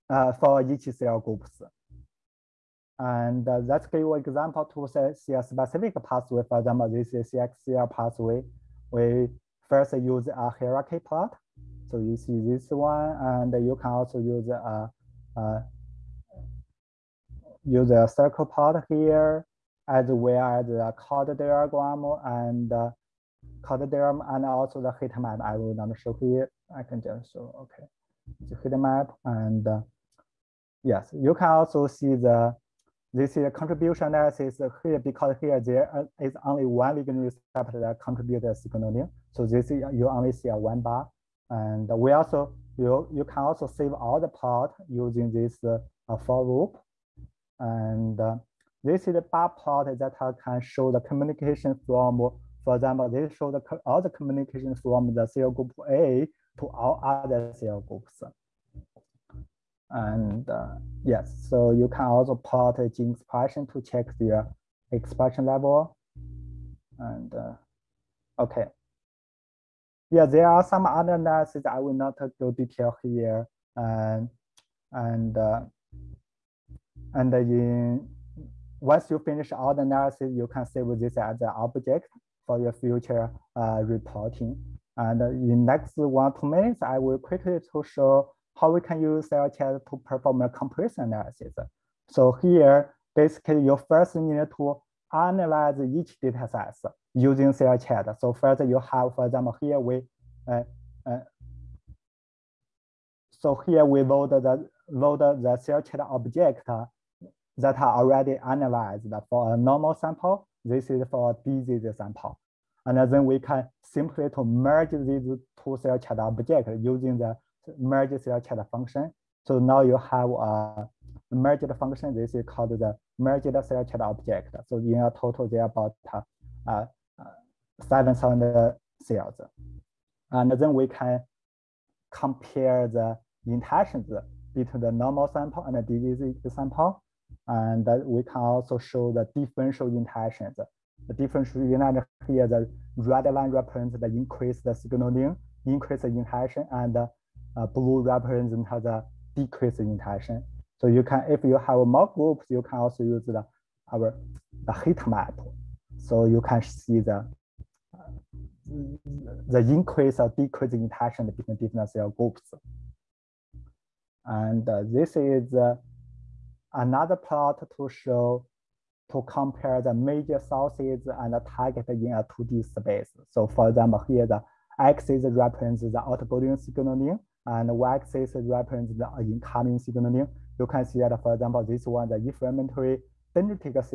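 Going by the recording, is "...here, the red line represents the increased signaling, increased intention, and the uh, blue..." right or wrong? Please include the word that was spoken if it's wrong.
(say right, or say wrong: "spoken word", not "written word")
right.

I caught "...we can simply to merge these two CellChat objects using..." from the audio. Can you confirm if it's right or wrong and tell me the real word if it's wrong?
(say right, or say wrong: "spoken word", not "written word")
right.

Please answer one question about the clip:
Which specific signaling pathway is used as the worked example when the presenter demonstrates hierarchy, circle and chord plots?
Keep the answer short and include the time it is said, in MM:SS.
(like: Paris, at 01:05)
CXCR, at 00:07.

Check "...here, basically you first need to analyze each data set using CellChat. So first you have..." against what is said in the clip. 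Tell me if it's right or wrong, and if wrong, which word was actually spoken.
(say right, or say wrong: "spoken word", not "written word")
right.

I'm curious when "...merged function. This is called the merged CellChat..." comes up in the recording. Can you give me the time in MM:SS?
02:01.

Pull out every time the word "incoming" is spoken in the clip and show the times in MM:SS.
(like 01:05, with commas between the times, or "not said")
02:59.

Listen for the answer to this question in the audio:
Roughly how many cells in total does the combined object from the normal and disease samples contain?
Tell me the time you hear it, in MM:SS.
02:07.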